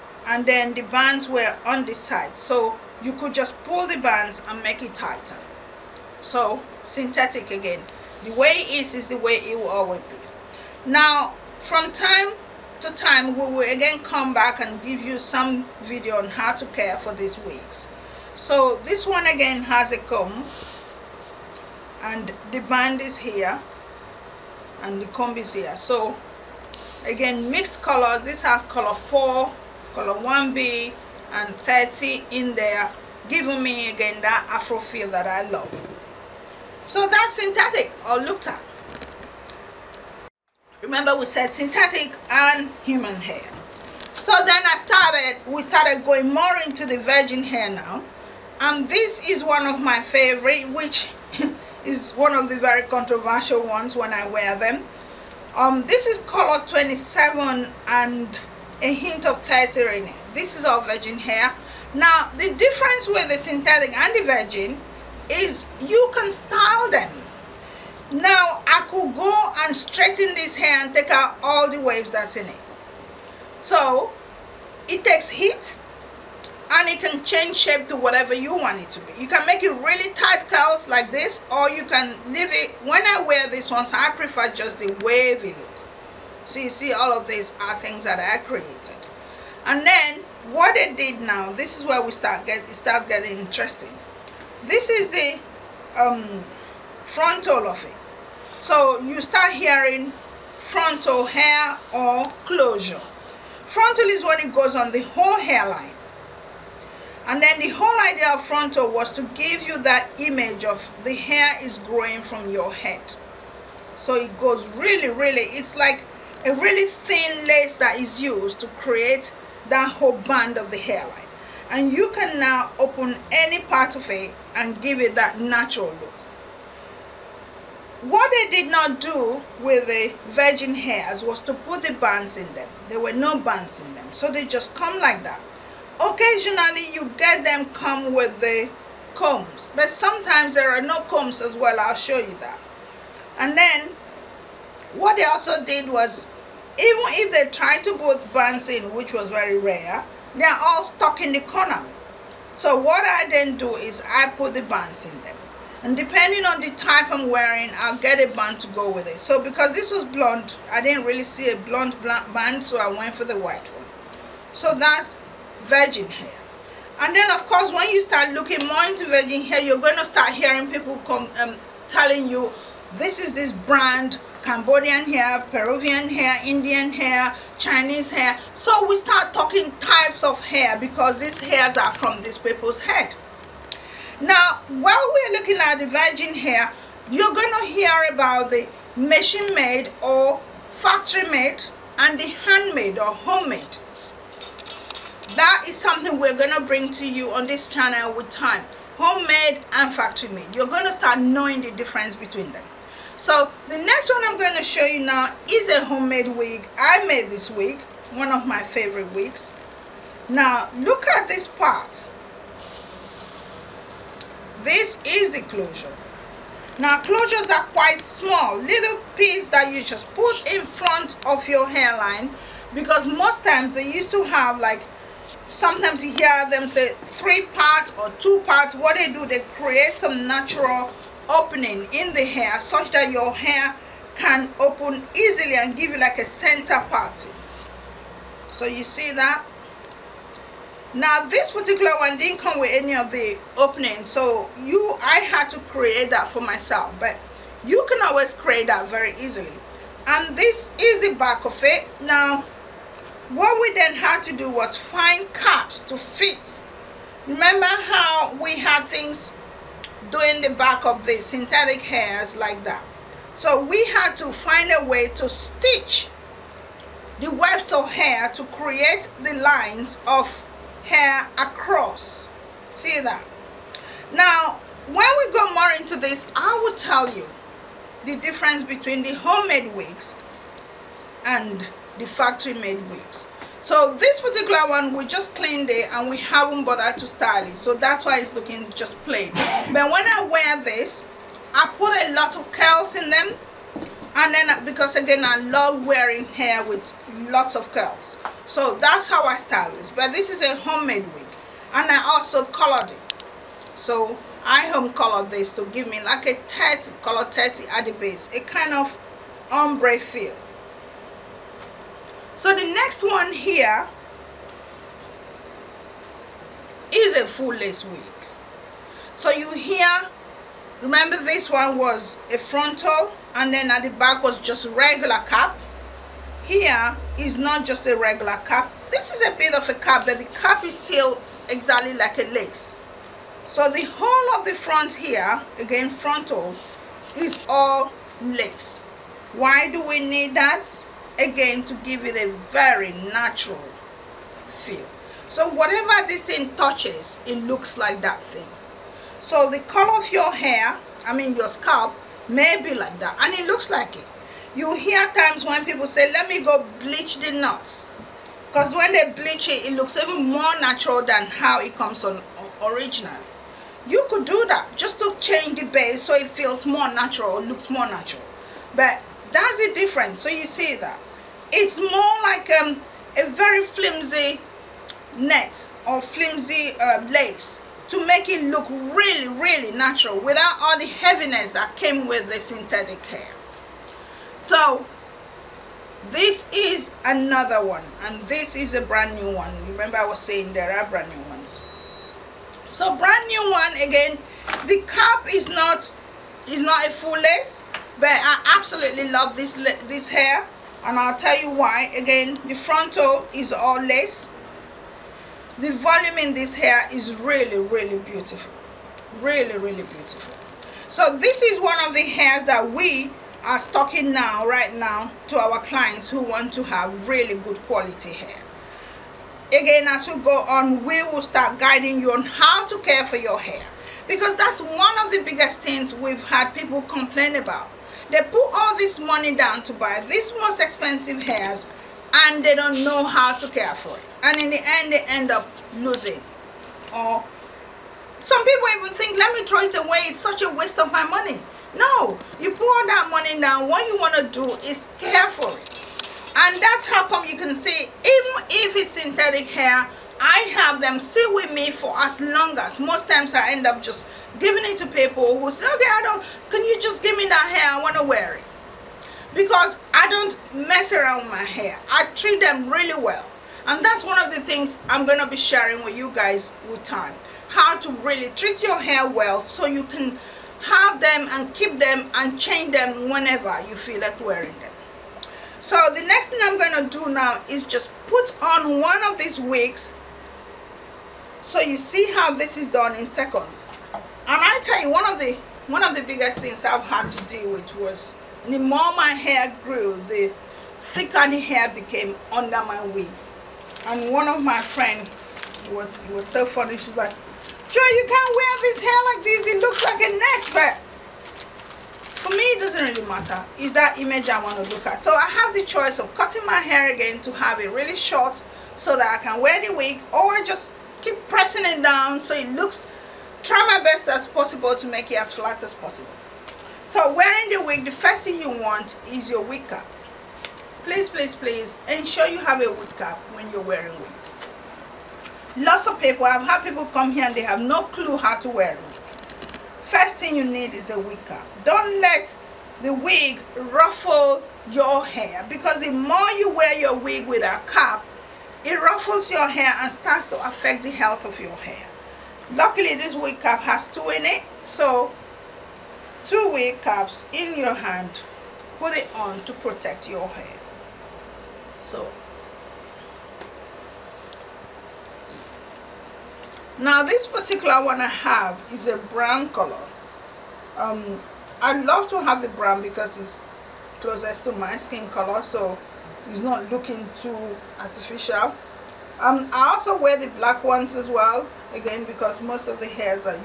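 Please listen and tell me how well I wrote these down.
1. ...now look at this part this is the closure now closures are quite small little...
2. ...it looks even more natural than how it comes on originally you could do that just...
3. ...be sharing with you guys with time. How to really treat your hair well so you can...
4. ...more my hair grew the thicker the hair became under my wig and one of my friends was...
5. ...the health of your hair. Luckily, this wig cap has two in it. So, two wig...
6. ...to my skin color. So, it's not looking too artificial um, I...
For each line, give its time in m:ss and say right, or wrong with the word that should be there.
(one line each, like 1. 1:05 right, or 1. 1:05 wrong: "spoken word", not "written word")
1. 3:30 right
2. 5:59 right
3. 7:45 right
4. 8:08 right
5. 9:00 right
6. 9:24 right.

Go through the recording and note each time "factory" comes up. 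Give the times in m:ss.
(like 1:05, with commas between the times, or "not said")
3:10, 3:19, 4:42.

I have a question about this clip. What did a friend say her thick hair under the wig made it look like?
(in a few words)
a nest.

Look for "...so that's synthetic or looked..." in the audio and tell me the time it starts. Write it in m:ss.
0:36.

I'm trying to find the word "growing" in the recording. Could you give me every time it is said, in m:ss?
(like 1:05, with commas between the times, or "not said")
1:51.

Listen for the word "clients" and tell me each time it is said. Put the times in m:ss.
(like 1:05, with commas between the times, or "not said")
6:55.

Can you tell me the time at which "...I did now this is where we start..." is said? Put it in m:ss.
1:30.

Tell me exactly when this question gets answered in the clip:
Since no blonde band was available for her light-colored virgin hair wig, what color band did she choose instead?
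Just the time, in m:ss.
2:43.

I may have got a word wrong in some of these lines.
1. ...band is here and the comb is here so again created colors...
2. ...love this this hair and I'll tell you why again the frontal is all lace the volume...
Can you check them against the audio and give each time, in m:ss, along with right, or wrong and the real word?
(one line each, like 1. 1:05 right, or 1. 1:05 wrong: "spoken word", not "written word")
1. 0:22 wrong: "mixed", not "created"
2. 6:39 right.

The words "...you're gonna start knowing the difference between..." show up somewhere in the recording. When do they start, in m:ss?
3:20.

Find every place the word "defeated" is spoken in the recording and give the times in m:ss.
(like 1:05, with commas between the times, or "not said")
not said.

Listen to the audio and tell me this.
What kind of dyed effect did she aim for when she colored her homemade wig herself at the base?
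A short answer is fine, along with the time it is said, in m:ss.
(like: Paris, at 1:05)
ombre, at 5:09.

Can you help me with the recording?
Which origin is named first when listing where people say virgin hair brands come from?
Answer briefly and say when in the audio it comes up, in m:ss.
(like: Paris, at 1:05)
Cambodian, at 2:54.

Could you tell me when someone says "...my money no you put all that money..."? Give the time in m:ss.
7:20.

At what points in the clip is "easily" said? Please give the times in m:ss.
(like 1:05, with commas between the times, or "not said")
3:55, 4:09.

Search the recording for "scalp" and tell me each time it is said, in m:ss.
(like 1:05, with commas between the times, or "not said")
5:51.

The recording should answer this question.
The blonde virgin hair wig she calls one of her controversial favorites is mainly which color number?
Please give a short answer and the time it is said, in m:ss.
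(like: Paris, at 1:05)
27, at 0:56.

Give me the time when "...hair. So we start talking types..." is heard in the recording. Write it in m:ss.
2:58.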